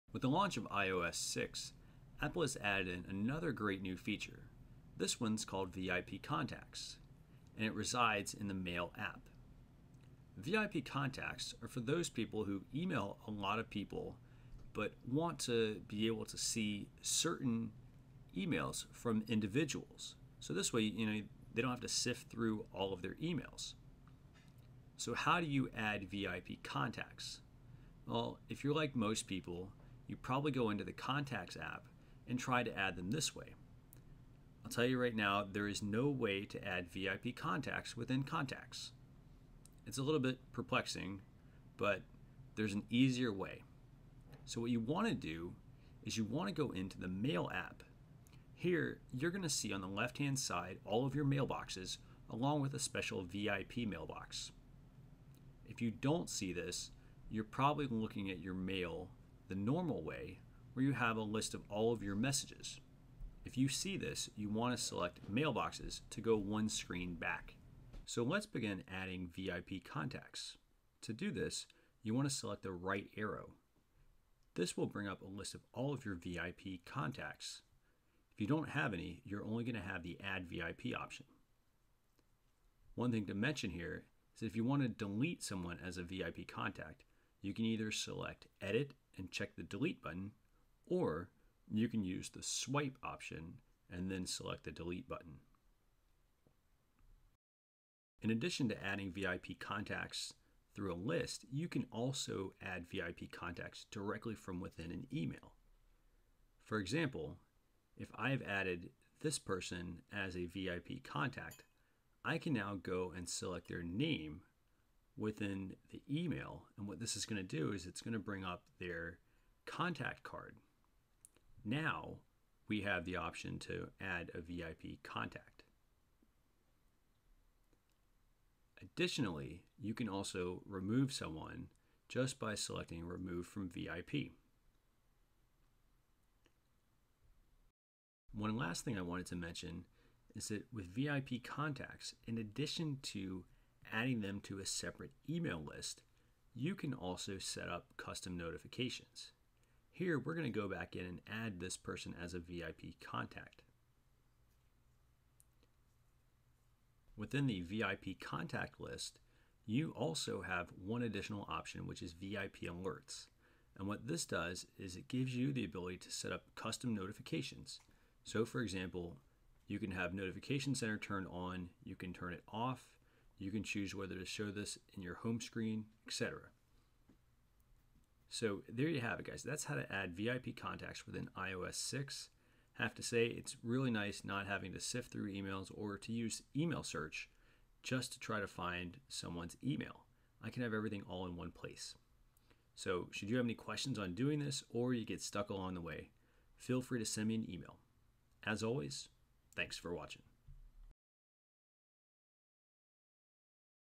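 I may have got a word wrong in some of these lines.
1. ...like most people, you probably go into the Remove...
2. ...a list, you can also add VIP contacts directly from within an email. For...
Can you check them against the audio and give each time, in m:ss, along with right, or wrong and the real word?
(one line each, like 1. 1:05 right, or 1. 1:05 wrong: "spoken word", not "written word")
1. 0:28 wrong: "Contacts", not "Remove"
2. 1:40 right.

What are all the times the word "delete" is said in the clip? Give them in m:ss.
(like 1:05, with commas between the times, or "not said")
1:24, 1:29, 1:34.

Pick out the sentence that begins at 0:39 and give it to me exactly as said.
It's a little bit perplexing, but there's an easier way.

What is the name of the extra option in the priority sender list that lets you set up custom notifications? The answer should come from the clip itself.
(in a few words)
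VIP alerts.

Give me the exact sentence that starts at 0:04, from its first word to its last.
This one's called VIP Contacts, and it resides in the Mail app.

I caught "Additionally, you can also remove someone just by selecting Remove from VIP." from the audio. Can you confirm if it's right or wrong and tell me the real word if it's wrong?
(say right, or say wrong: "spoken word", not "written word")
right.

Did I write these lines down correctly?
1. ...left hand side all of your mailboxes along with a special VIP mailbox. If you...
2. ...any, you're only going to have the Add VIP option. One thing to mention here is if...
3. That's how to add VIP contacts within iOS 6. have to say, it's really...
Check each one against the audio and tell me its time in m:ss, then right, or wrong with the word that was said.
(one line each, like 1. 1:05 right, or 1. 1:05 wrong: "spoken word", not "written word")
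1. 0:49 right
2. 1:18 right
3. 2:59 right.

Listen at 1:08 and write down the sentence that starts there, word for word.
So let's begin adding VIP contacts.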